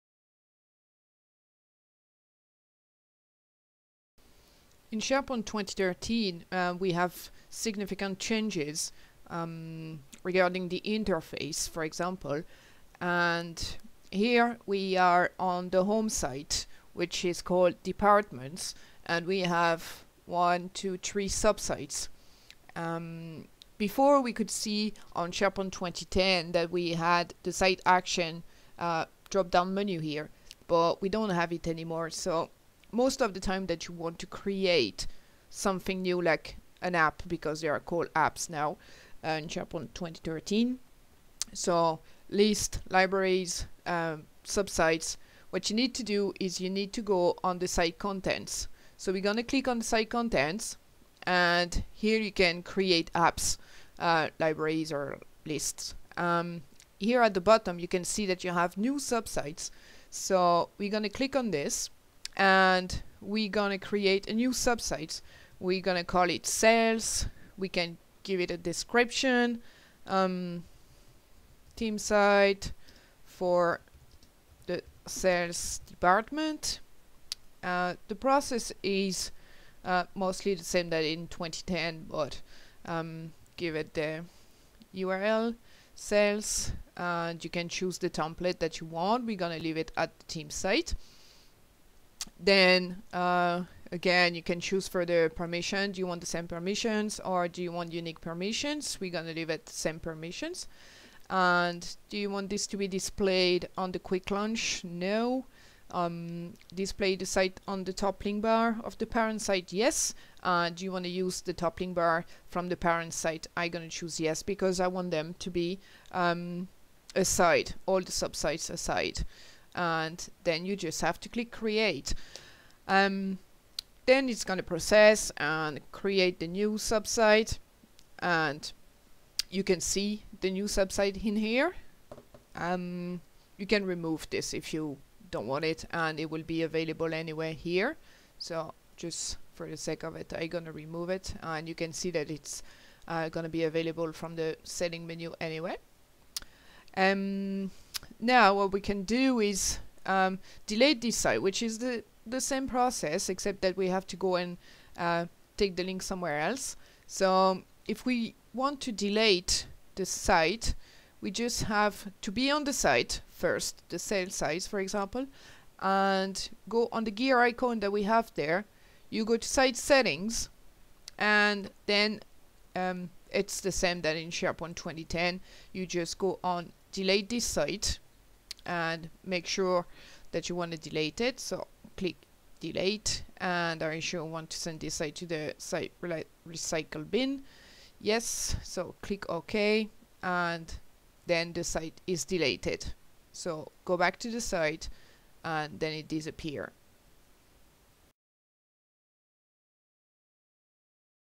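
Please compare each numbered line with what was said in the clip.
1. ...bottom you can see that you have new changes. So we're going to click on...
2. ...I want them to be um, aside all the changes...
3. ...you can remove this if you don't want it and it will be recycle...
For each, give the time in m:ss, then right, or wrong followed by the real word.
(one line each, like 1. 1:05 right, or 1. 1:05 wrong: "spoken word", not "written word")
1. 0:57 wrong: "subsites", not "changes"
2. 1:54 wrong: "subsites", not "changes"
3. 2:13 wrong: "available", not "recycle".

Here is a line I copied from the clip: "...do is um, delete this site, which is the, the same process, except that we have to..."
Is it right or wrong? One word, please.
right.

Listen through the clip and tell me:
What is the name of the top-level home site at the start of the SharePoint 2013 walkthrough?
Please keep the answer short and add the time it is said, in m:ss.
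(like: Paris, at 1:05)
departments, at 0:17.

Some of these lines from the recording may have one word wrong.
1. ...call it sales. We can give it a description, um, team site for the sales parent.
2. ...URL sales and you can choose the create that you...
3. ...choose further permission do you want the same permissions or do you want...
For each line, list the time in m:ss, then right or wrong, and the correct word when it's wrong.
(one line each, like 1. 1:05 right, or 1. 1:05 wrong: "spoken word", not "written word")
1. 1:06 wrong: "department", not "parent"
2. 1:24 wrong: "template", not "create"
3. 1:34 right.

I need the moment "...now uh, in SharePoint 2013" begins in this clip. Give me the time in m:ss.
0:38.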